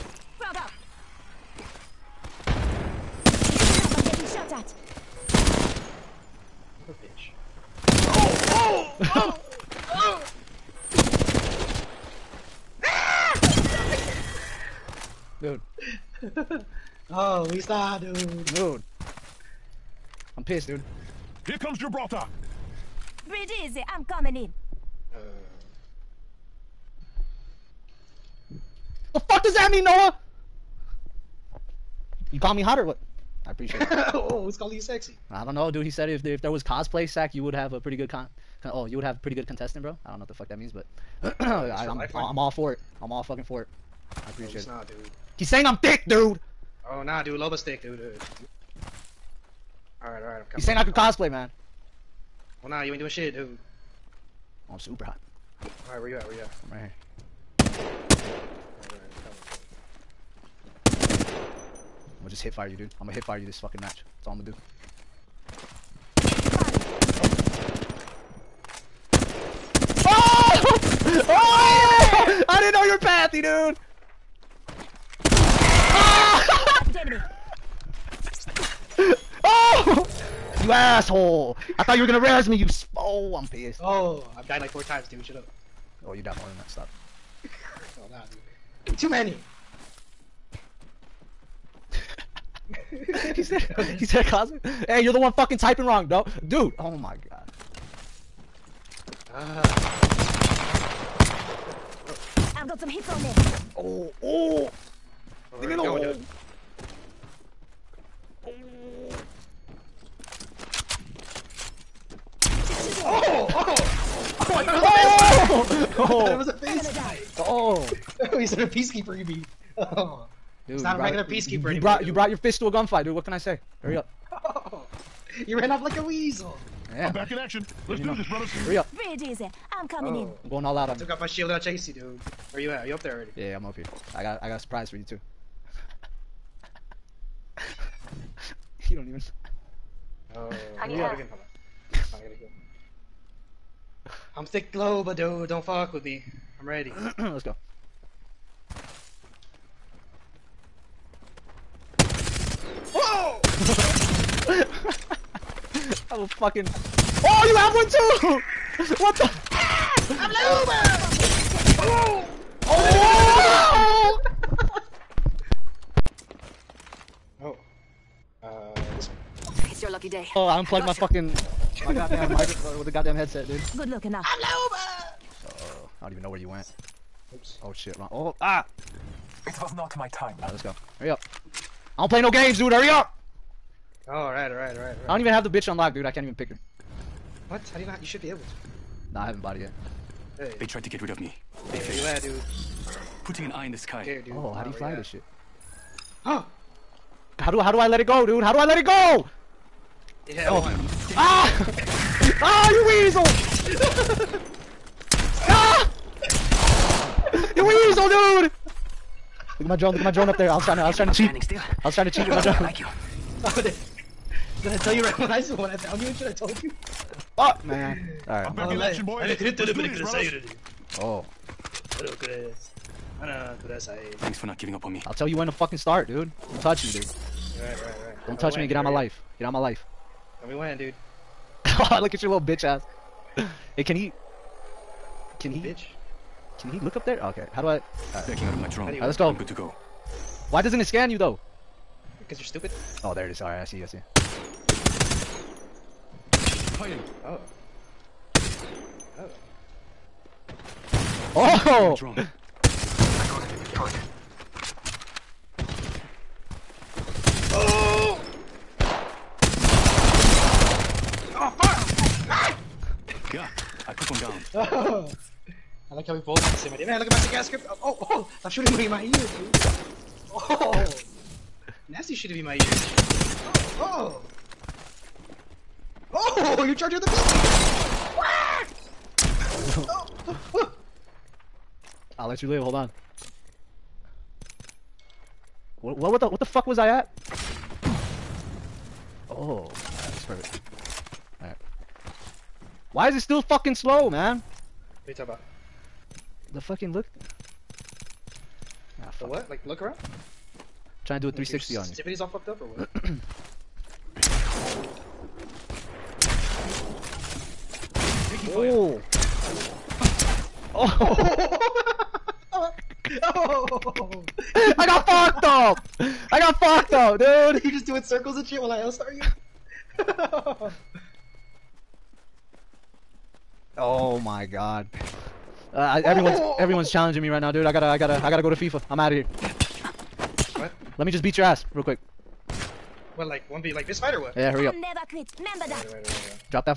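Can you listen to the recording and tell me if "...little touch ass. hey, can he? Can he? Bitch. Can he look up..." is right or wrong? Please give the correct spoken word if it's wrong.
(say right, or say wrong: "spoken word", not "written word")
wrong: "bitch", not "touch".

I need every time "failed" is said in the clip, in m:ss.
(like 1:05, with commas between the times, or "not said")
3:11.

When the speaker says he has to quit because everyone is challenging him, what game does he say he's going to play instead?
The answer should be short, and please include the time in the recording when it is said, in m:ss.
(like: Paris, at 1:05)
FIFA, at 5:28.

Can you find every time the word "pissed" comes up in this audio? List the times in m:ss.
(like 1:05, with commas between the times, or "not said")
0:20, 1:23.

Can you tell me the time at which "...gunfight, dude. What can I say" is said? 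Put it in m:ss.
2:02.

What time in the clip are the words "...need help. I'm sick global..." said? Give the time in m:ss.
2:20.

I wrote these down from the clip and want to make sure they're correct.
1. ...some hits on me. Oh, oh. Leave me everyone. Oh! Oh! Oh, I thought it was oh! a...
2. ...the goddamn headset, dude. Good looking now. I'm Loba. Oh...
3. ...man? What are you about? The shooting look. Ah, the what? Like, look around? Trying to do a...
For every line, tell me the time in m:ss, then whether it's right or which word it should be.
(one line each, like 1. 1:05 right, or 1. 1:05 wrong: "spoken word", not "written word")
1. 1:42 wrong: "alone", not "everyone"
2. 2:52 right
3. 4:54 wrong: "fucking", not "shooting".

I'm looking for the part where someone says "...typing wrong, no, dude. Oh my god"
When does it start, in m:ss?
1:35.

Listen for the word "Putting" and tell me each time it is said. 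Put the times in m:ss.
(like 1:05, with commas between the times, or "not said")
3:13.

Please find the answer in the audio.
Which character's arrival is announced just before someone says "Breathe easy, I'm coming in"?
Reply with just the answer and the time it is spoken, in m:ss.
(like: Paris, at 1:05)
Gibraltar, at 0:21.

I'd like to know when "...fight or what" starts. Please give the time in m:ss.
5:33.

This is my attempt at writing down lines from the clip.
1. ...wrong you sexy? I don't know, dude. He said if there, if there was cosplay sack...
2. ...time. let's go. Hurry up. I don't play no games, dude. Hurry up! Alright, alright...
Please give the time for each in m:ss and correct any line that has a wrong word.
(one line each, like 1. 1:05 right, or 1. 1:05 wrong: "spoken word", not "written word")
1. 0:34 wrong: "calling", not "wrong"
2. 3:00 right.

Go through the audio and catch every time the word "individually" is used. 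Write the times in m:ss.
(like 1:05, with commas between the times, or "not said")
not said.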